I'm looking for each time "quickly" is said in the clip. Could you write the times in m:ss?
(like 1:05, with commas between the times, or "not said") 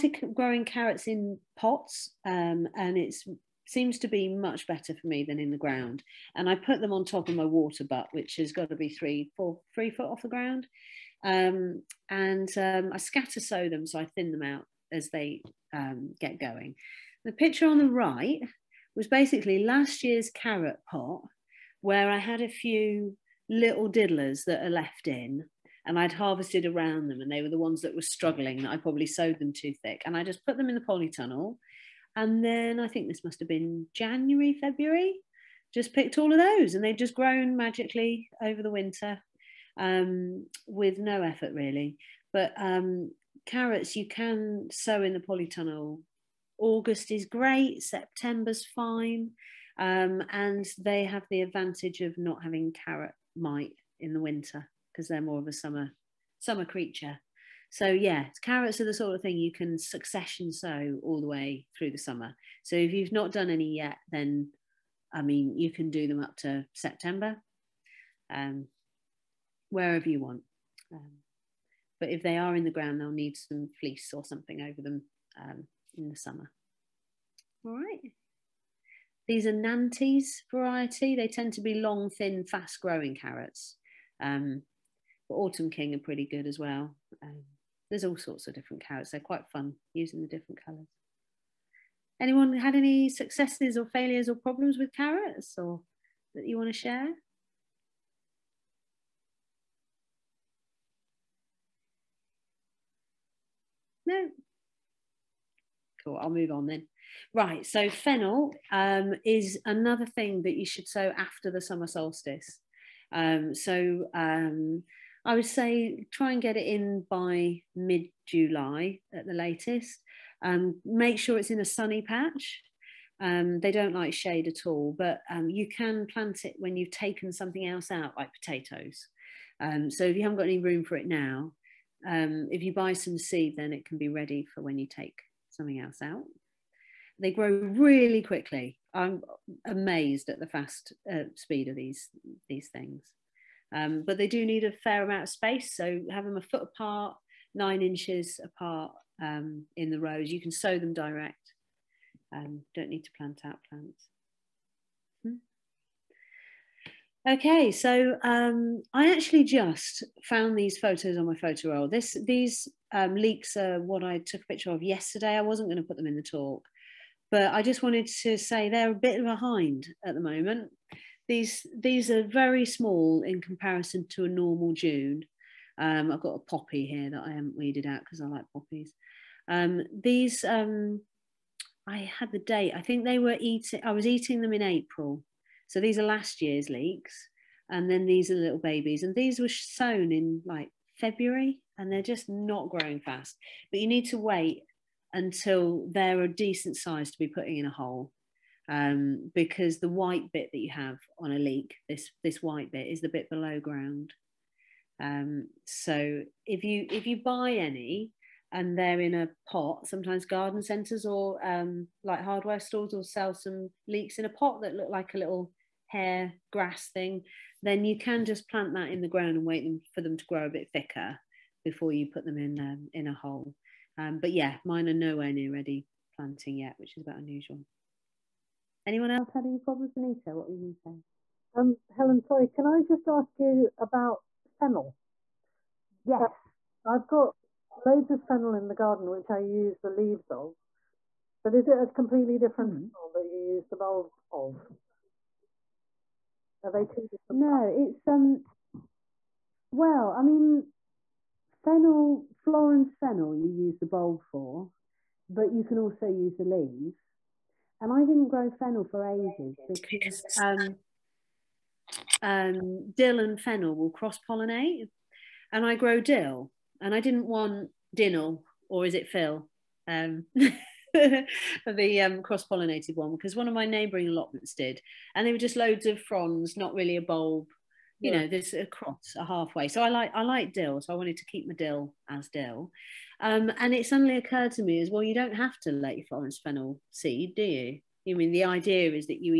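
2:18.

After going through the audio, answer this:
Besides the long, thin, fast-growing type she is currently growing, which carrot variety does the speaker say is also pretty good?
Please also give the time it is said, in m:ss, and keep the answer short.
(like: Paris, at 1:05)
Autumn King, at 1:25.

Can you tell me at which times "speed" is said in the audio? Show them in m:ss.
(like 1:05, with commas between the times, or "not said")
2:21.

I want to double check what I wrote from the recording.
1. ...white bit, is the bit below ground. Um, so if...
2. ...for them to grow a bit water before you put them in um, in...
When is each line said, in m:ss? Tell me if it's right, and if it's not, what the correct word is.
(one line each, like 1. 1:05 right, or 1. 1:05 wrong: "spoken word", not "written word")
1. 3:22 right
2. 3:39 wrong: "thicker", not "water".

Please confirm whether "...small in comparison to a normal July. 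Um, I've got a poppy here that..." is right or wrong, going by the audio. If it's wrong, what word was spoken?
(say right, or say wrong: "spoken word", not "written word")
wrong: "June", not "July".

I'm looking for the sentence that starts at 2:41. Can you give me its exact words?
This, these um, leeks are what I took a picture of yesterday.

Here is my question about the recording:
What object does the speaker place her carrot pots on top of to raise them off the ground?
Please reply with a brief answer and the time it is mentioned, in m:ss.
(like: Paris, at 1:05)
Water butt, at 0:07.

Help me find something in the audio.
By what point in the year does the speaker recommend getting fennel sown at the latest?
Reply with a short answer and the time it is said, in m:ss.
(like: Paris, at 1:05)
Mid July, at 1:57.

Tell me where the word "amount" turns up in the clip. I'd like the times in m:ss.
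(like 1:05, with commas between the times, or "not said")
2:25.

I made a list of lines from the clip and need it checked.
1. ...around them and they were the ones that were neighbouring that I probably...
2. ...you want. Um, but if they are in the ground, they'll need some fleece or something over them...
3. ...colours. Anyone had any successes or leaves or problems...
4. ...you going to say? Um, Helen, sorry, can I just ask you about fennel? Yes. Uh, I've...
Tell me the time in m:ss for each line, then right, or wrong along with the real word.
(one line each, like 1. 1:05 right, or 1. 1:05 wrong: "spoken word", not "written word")
1. 0:26 wrong: "struggling", not "neighbouring"
2. 1:10 right
3. 1:30 wrong: "failures", not "leaves"
4. 3:50 right.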